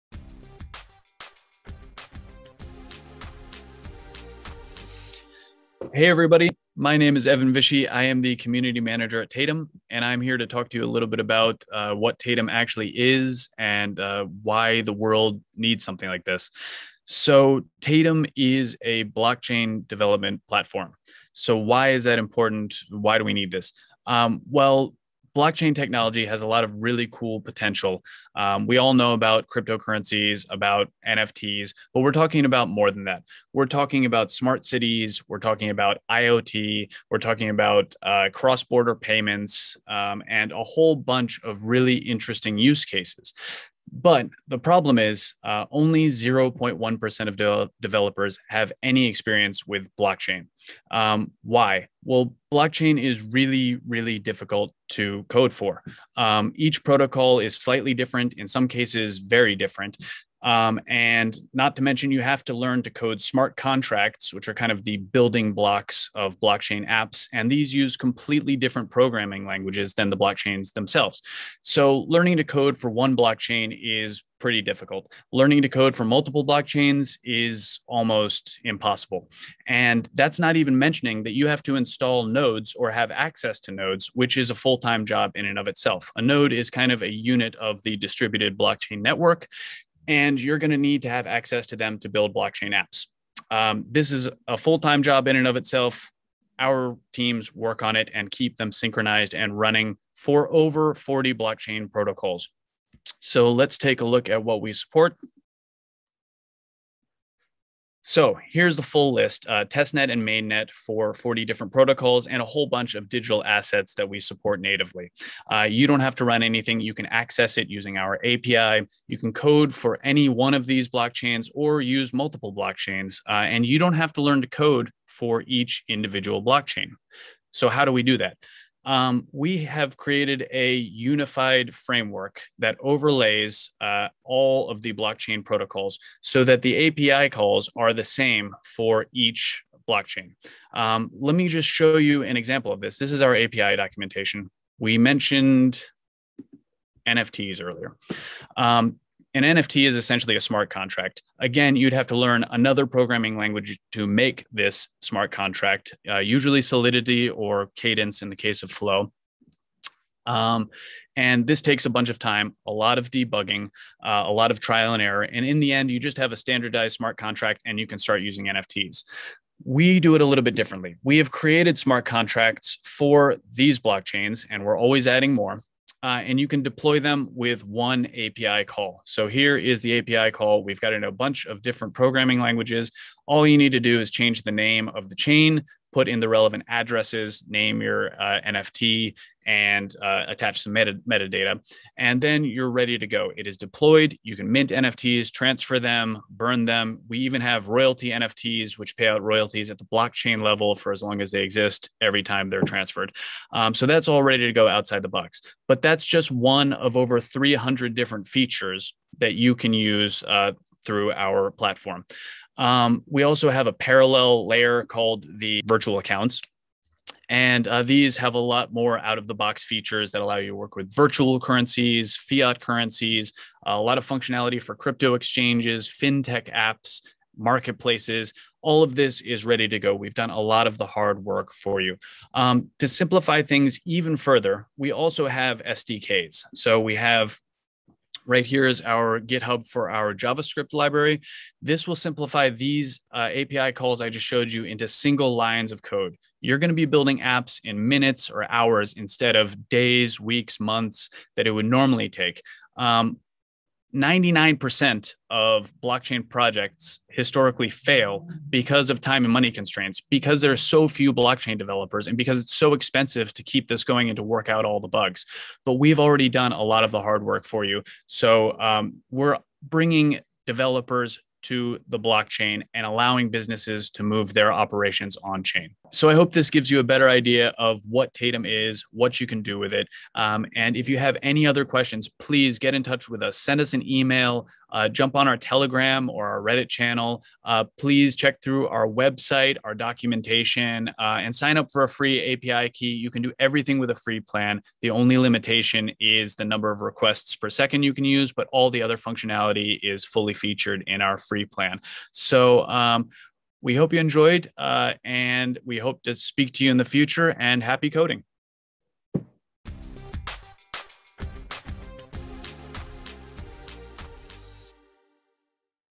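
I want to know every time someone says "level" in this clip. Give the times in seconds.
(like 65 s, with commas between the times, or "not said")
200 s.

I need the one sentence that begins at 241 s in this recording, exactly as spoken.
This will simplify these uh, API calls I just showed you into single lines of code.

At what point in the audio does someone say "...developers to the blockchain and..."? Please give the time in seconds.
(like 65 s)
270 s.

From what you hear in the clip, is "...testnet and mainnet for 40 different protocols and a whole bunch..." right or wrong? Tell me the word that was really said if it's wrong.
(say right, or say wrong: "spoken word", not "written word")
right.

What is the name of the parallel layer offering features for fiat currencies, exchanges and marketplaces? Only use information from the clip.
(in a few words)
virtual accounts.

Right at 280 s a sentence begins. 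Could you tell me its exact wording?
Um, and if you have any other questions, please get in touch with us.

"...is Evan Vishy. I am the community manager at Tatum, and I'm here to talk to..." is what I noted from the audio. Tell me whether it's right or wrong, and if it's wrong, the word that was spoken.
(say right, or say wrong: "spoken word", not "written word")
right.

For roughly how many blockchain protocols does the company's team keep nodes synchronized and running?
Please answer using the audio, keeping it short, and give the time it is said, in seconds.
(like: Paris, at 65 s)
over 40, at 100 s.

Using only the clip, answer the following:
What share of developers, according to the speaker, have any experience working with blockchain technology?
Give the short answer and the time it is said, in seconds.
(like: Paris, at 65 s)
0.1%, at 46 s.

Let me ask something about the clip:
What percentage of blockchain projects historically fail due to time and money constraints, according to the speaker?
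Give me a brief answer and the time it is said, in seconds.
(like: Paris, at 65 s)
99%, at 253 s.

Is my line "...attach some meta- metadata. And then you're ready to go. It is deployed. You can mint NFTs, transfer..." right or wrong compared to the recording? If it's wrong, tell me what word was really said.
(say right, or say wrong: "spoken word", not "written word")
right.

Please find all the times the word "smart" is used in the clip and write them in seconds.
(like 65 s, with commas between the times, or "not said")
34 s, 63 s, 150 s, 155 s, 166 s, 171 s.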